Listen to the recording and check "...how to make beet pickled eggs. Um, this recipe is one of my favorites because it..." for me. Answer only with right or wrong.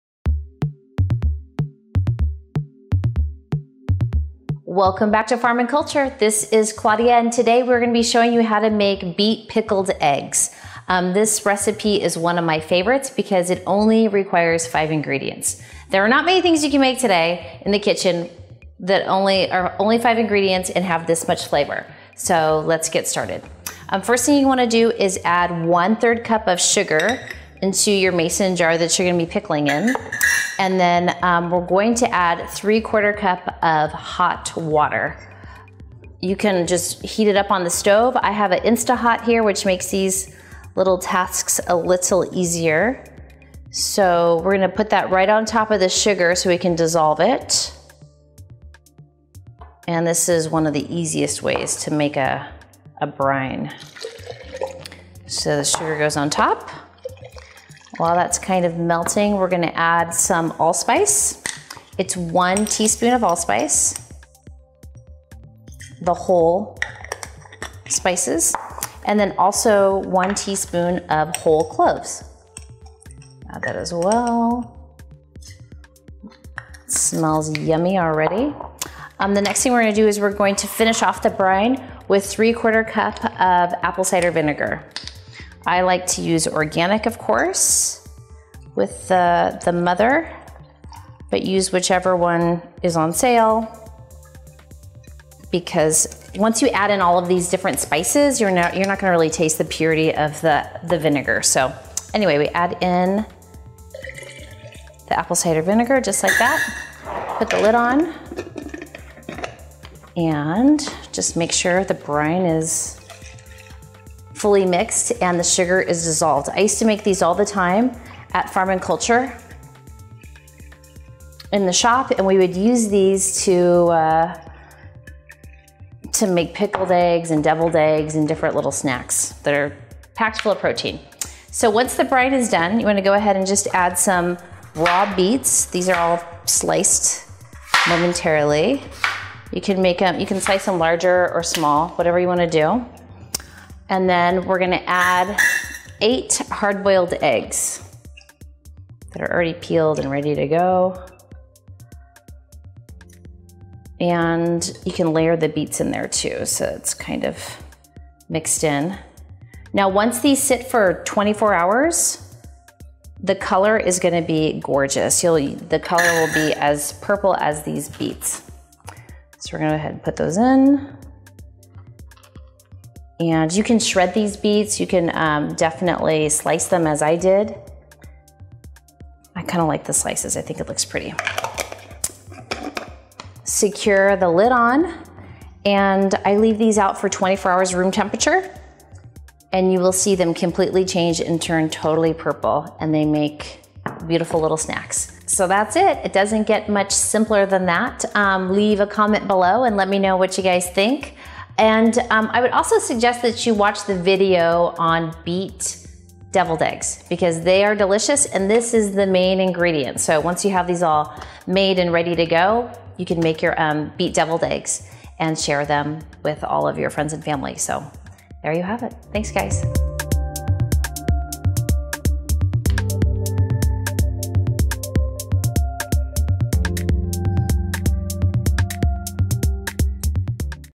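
right.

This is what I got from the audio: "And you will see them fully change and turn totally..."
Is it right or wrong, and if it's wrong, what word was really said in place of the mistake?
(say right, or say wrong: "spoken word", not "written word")
wrong: "completely", not "fully".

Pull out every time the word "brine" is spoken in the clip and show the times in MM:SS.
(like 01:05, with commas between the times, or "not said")
00:53, 01:21, 01:51, 02:12.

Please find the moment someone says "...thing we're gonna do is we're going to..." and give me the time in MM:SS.
01:19.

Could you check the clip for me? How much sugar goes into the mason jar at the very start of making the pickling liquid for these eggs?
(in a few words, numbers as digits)
1/3 cup.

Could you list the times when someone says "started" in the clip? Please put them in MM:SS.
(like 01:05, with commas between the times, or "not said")
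00:23.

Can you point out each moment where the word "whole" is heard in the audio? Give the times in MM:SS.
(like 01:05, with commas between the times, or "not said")
01:06, 01:11.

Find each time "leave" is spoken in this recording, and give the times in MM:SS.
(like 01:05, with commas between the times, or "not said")
03:06, 03:18.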